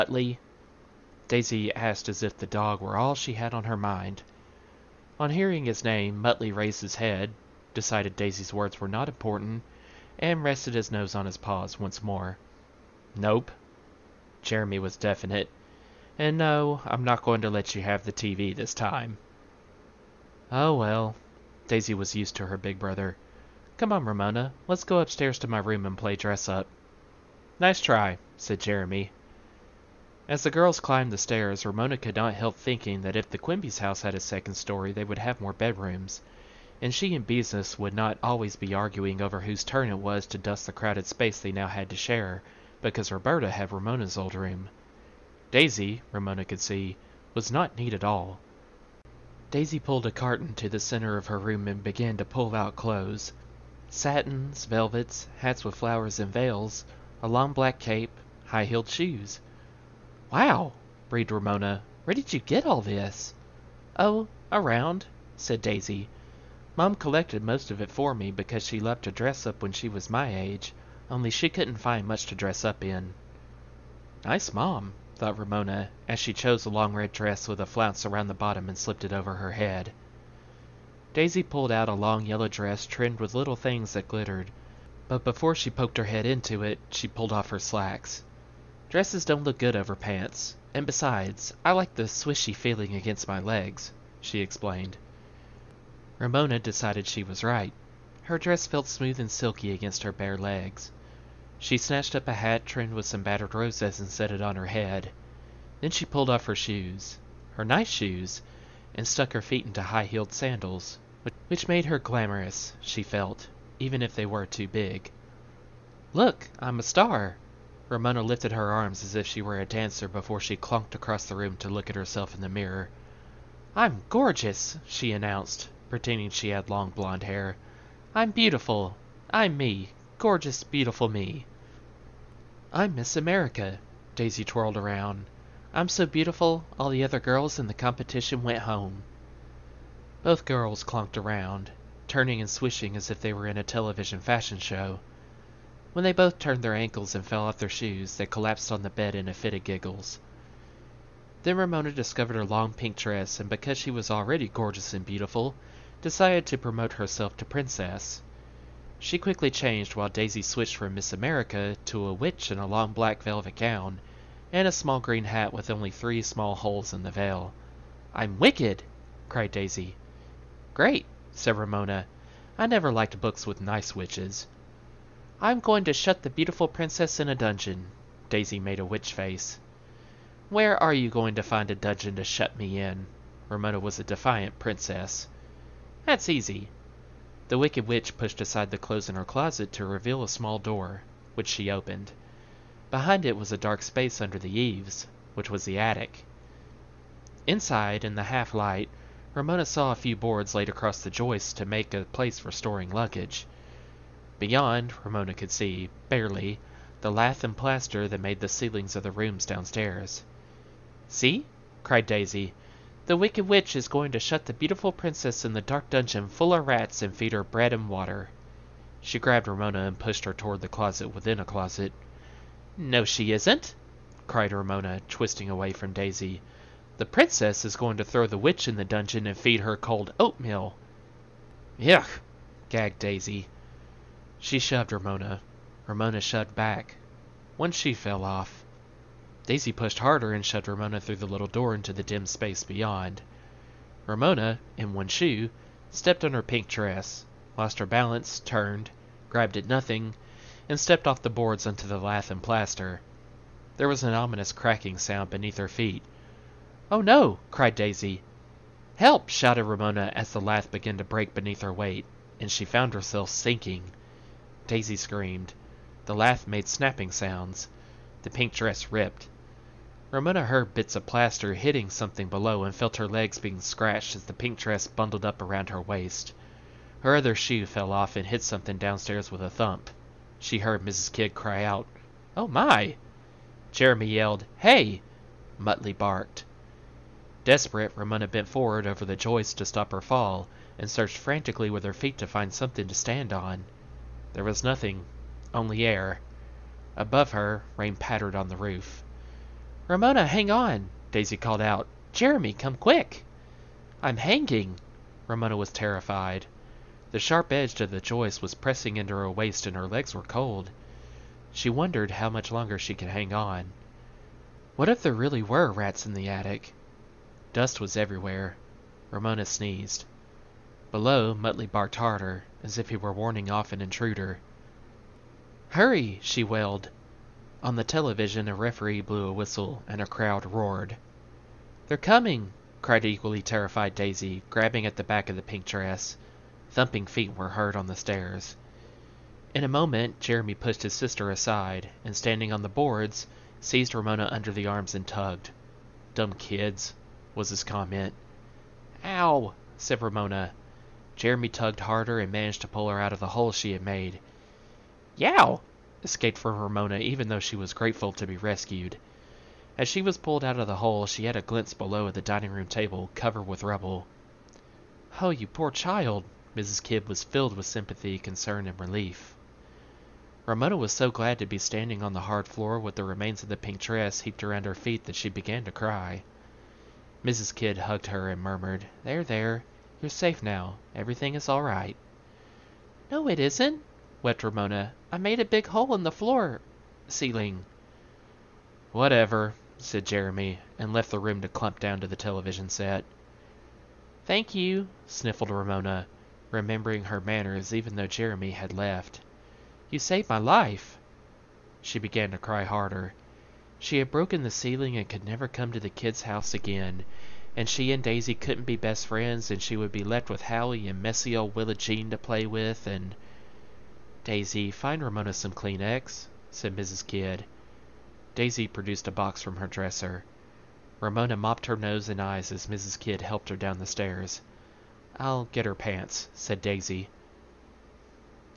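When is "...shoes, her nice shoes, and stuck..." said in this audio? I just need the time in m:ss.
1:46.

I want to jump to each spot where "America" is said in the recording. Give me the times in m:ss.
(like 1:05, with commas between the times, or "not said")
2:13, 2:41.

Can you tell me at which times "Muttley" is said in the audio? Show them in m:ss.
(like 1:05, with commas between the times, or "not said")
0:06, 4:45, 5:21.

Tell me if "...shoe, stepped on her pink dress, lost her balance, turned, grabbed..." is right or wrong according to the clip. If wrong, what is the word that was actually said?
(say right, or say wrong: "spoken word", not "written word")
right.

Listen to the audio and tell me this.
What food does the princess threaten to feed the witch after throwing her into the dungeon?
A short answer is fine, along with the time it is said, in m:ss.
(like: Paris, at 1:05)
Cold oatmeal, at 3:49.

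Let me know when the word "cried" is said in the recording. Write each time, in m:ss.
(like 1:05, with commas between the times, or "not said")
2:49, 3:31, 3:44, 4:17, 5:32.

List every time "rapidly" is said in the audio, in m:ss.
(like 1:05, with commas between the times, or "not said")
not said.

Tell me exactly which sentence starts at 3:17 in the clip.
Inside, in the half light, Ramona saw a few boards laid across the joists to make a place for storing luggage.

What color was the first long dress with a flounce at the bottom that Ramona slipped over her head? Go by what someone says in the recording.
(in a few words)
Red.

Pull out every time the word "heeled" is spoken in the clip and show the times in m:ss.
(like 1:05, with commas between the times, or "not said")
0:58, 1:50.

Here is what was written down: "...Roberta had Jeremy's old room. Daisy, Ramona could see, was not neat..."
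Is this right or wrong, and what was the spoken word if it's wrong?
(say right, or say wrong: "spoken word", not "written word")
wrong: "Ramona", not "Jeremy".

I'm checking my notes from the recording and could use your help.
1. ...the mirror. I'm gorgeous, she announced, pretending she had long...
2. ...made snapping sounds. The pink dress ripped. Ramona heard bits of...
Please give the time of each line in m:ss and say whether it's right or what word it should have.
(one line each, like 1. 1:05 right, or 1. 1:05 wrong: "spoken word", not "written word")
1. 2:02 right
2. 4:26 right.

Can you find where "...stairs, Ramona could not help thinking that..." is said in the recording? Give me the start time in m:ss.
0:31.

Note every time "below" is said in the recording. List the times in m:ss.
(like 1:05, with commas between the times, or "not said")
4:32, 5:20, 6:01.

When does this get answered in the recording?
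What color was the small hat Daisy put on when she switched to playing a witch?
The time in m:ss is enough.
2:44.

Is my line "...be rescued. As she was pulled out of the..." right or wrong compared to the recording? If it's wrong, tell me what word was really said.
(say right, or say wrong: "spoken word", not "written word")
right.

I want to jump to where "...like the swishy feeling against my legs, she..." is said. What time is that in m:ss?
1:31.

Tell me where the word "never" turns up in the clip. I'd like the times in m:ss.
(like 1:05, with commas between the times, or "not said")
2:52, 6:45.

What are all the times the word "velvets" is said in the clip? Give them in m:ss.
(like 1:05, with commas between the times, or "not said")
0:54, 2:43.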